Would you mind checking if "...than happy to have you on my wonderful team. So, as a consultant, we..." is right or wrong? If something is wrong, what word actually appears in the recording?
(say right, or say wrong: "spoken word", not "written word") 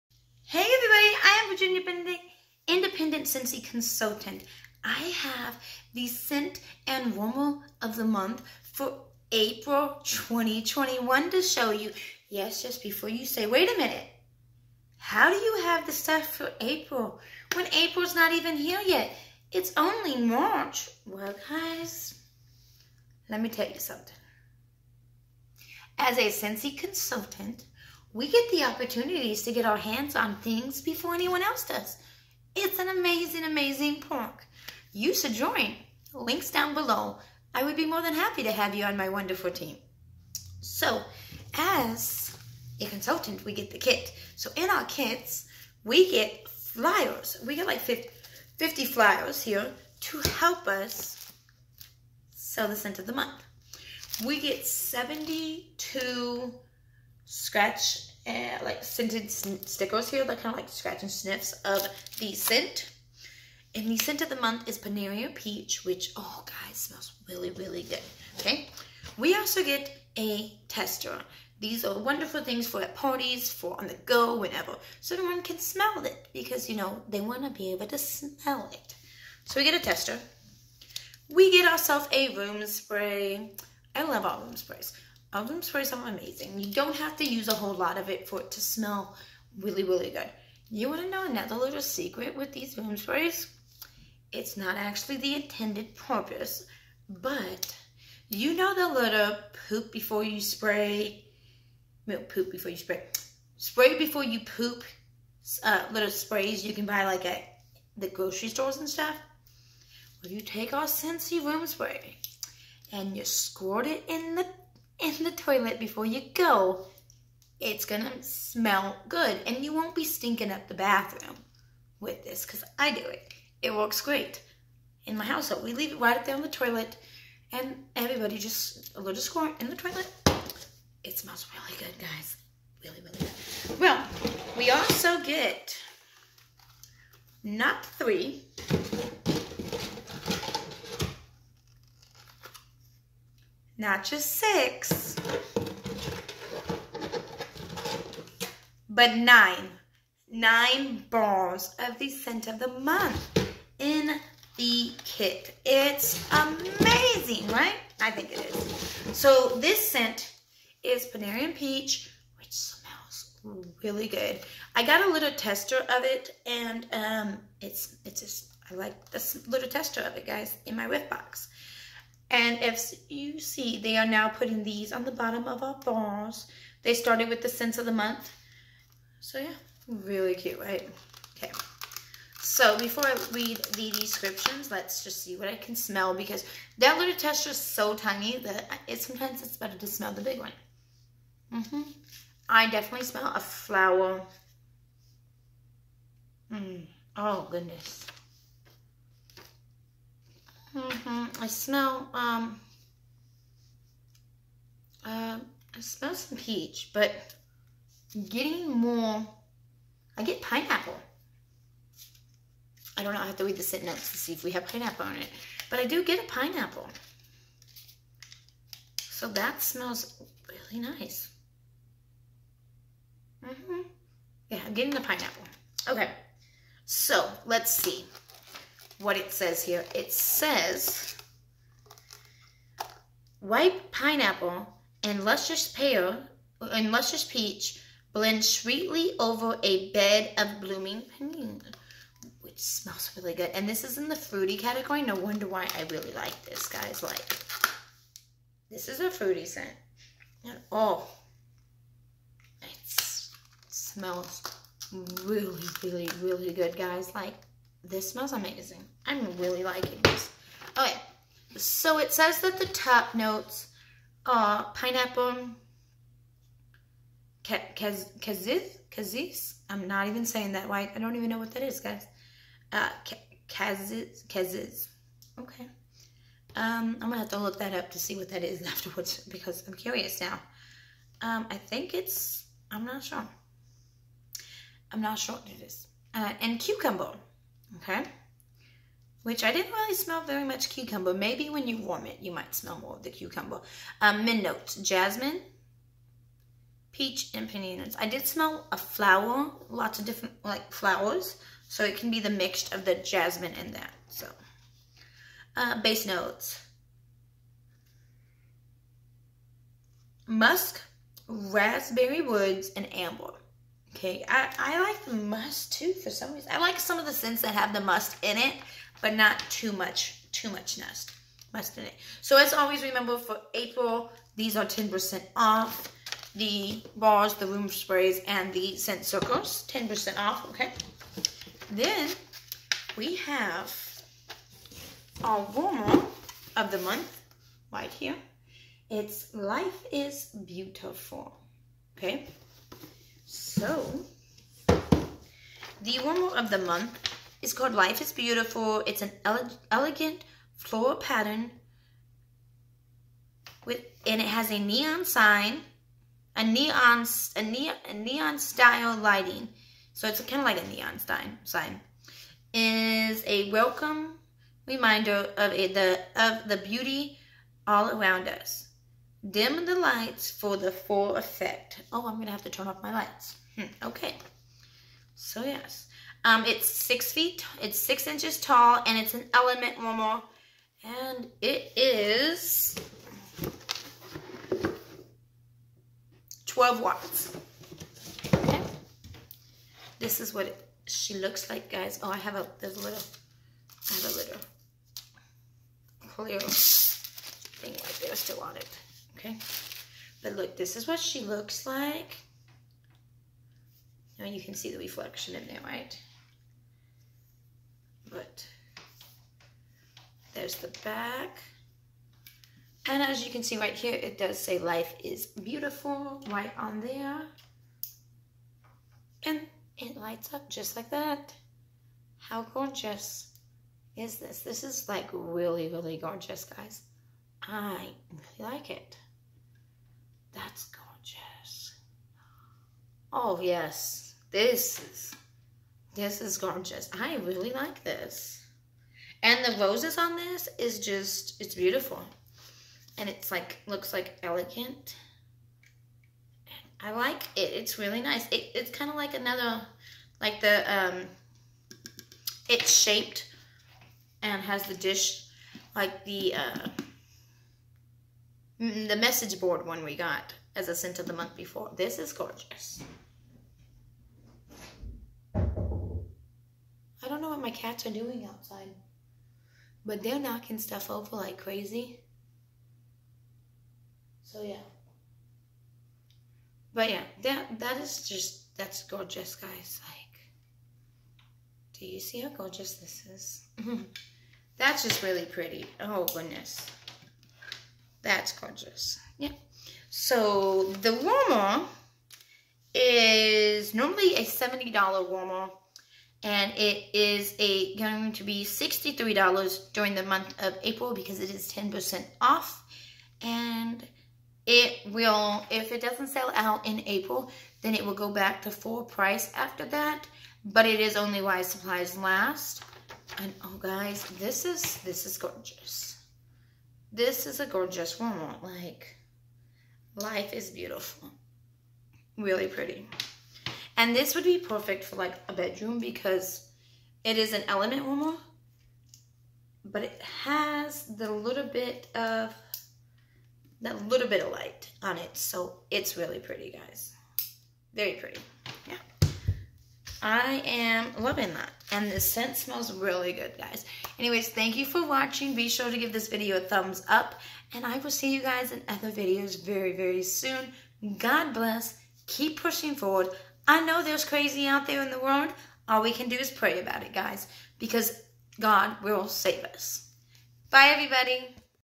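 right.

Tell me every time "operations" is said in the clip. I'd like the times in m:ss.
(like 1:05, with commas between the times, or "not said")
not said.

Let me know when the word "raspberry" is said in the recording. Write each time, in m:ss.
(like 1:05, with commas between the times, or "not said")
5:11.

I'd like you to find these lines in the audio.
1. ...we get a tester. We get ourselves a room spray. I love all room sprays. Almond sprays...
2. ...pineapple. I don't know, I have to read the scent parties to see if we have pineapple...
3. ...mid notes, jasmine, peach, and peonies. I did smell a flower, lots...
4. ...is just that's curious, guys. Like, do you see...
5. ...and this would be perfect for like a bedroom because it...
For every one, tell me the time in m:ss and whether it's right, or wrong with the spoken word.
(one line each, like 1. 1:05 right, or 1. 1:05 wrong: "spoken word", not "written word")
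1. 1:19 right
2. 3:30 wrong: "notes", not "parties"
3. 4:54 right
4. 7:57 wrong: "gorgeous", not "curious"
5. 8:43 right.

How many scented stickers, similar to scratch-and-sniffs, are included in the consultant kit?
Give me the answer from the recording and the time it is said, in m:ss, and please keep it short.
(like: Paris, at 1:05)
72, at 0:54.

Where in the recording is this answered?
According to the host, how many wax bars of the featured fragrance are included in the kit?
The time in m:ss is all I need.
2:30.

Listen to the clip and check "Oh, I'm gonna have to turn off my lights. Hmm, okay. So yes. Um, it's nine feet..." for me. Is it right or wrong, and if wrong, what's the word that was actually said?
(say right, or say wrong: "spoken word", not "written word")
wrong: "six", not "nine".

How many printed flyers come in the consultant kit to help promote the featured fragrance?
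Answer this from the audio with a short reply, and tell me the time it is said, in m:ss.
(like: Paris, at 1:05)
50, at 0:47.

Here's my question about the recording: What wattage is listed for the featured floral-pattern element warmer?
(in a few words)
12 watts.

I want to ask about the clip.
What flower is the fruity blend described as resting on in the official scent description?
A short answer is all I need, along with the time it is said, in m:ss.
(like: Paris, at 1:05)
peony, at 4:00.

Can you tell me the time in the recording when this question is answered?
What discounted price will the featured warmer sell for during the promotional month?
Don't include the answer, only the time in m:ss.
8:18.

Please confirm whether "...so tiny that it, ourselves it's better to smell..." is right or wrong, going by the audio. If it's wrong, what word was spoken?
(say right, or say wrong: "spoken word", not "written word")
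wrong: "sometimes", not "ourselves".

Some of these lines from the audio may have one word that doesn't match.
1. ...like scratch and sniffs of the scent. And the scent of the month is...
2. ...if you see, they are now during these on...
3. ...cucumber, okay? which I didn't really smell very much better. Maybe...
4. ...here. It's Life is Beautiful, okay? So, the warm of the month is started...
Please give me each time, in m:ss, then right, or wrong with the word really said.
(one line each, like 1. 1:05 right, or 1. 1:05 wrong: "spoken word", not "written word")
1. 1:00 right
2. 2:52 wrong: "putting", not "during"
3. 4:46 wrong: "cucumber", not "better"
4. 5:37 wrong: "called", not "started".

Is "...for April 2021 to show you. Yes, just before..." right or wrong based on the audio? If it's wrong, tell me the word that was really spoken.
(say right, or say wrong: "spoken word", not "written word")
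right.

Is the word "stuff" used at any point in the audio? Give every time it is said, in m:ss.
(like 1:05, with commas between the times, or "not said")
0:15, 1:48, 7:50.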